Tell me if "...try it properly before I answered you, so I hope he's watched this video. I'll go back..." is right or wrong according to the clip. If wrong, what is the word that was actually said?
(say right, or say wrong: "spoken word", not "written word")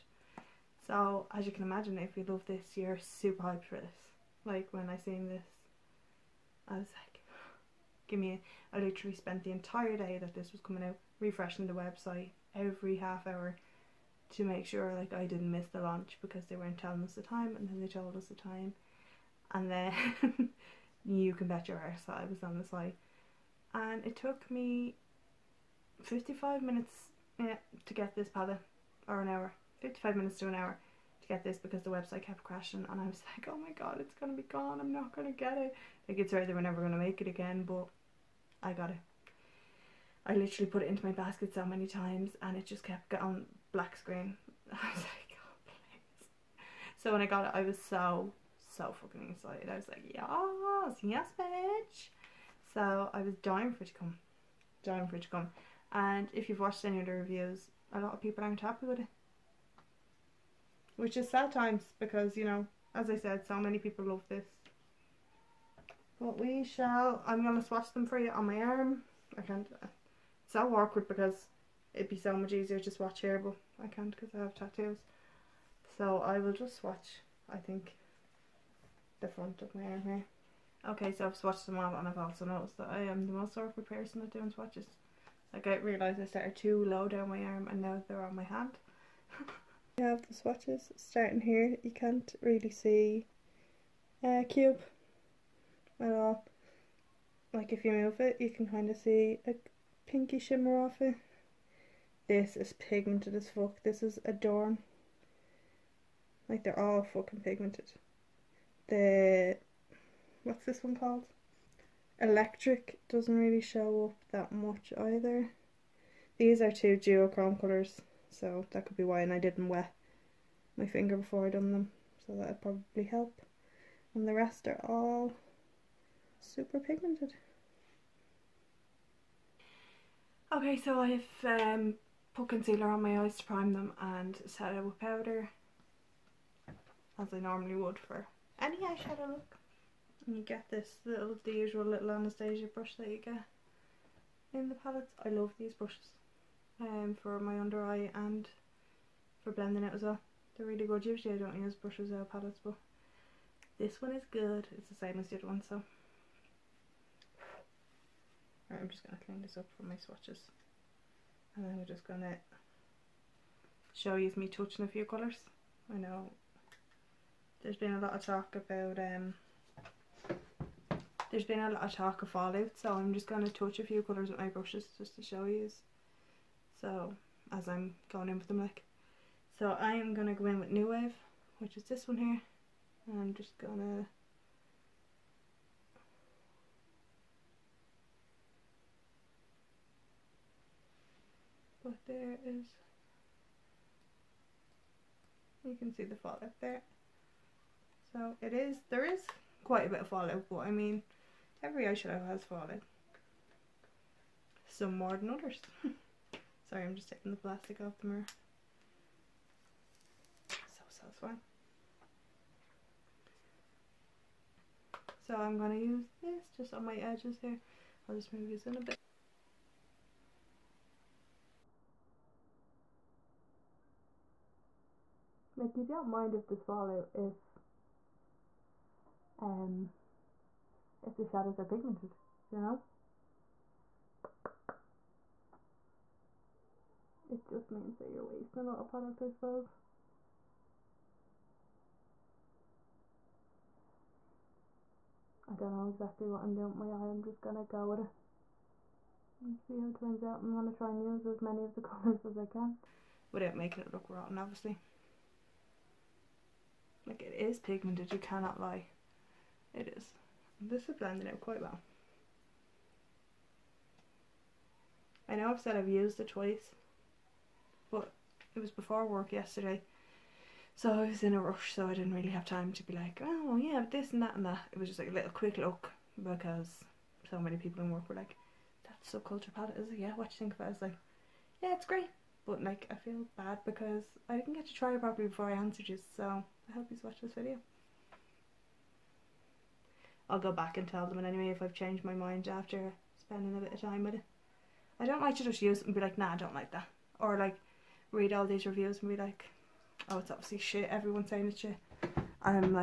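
right.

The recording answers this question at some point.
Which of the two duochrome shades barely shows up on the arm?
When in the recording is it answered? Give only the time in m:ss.
1:52.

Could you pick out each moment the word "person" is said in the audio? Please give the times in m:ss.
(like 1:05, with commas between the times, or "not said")
1:23.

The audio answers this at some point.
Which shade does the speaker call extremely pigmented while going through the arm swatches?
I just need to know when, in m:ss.
1:44.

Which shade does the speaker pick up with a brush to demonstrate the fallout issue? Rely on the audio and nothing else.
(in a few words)
New Wave.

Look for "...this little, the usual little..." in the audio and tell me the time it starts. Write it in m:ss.
2:20.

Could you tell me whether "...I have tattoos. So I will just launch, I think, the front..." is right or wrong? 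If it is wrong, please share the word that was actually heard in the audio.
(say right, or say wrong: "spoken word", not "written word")
wrong: "swatch", not "launch".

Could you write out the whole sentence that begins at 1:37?
Like if you move it, you can kind of see a pinky shimmer off it.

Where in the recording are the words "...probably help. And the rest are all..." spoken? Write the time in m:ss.
2:02.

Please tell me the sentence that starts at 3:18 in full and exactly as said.
So it is, there is quite a bit of fallout, but I mean, every eyeshadow has fallout.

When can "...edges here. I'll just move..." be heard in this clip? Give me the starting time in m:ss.
3:36.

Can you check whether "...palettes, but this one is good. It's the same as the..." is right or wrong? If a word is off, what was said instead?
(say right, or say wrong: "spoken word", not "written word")
right.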